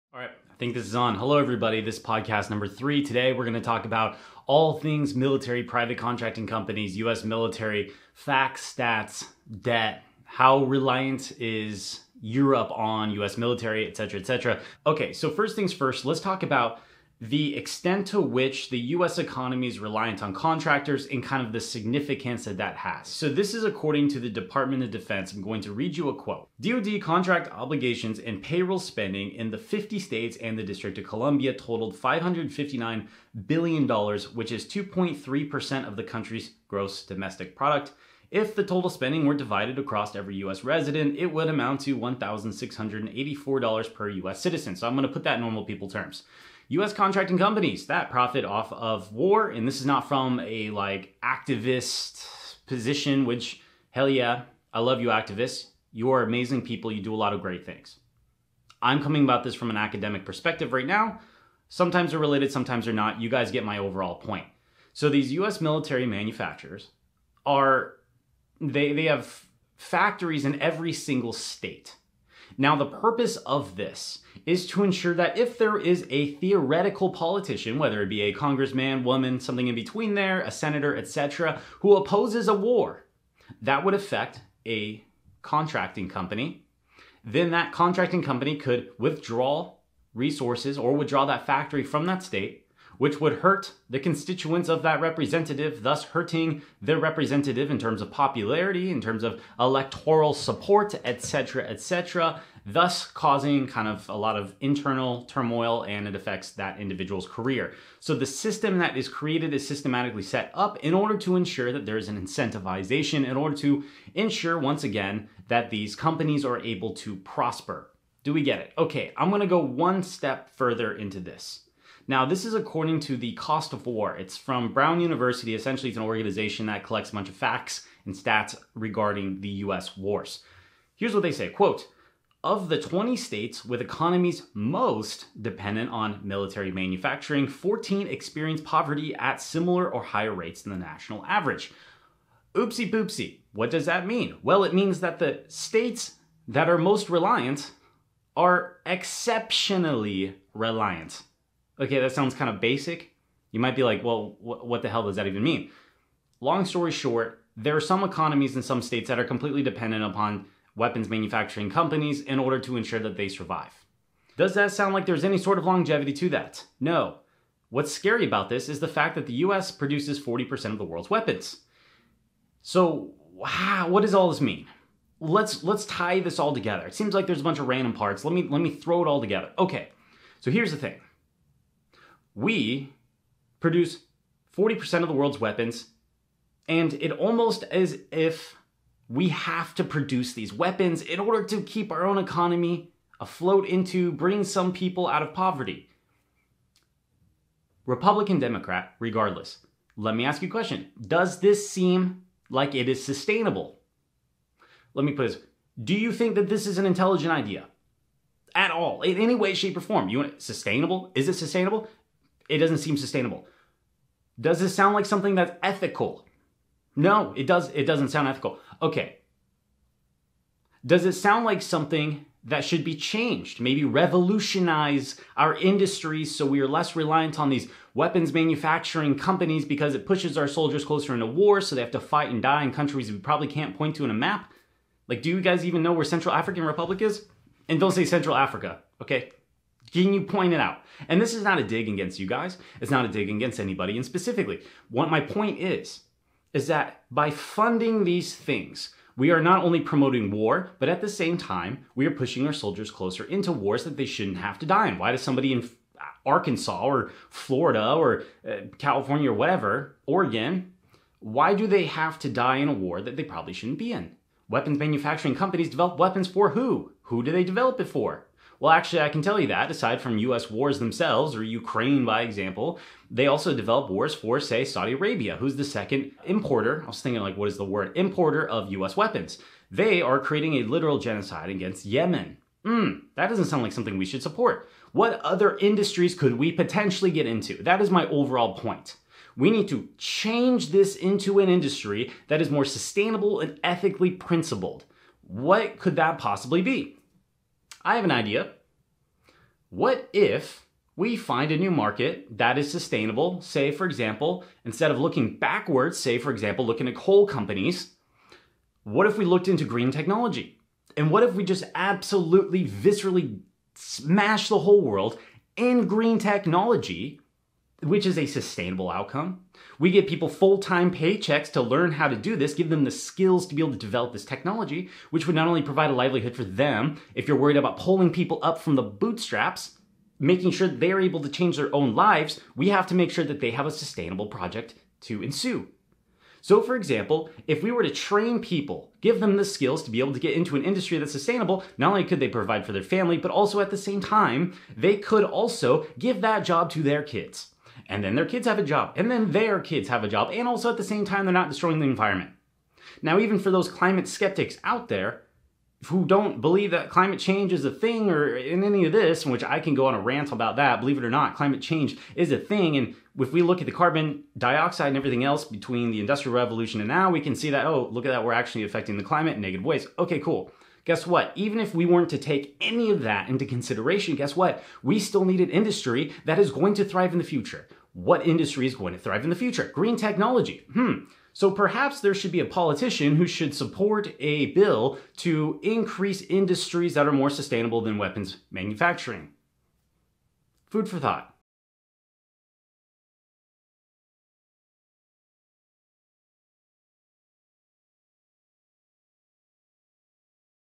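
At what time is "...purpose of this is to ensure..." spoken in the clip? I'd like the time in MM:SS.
01:12.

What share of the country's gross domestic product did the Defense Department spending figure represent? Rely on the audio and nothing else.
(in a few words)
2.3%.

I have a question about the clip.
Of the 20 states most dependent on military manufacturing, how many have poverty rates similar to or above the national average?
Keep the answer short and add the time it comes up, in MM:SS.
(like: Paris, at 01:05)
14, at 02:17.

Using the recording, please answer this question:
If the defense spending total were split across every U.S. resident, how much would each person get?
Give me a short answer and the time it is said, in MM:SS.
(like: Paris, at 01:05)
$1,684, at 00:41.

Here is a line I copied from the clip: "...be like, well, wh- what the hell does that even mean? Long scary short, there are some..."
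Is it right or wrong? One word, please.
wrong.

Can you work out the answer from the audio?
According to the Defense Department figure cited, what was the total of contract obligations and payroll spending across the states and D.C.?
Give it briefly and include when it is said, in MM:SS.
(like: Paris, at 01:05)
$559 billion, at 00:31.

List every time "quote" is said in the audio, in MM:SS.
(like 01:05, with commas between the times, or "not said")
00:26, 02:11.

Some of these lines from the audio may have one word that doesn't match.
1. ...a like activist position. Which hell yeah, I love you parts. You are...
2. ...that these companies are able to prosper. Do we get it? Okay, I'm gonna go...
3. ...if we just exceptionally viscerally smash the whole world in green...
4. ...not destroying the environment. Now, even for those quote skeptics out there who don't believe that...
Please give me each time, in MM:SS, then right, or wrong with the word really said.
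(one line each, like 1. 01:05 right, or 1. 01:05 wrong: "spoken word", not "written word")
1. 00:50 wrong: "activists", not "parts"
2. 01:55 right
3. 05:11 wrong: "absolutely", not "exceptionally"
4. 05:51 wrong: "climate", not "quote".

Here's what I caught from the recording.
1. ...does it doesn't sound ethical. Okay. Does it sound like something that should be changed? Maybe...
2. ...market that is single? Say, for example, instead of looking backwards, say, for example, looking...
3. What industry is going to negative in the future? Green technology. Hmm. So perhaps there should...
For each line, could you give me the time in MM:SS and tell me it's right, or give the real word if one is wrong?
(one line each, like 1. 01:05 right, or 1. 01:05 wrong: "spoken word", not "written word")
1. 03:37 right
2. 05:01 wrong: "sustainable", not "single"
3. 06:17 wrong: "thrive", not "negative".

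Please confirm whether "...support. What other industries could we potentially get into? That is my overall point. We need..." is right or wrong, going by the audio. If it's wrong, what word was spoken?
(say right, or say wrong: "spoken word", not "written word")
right.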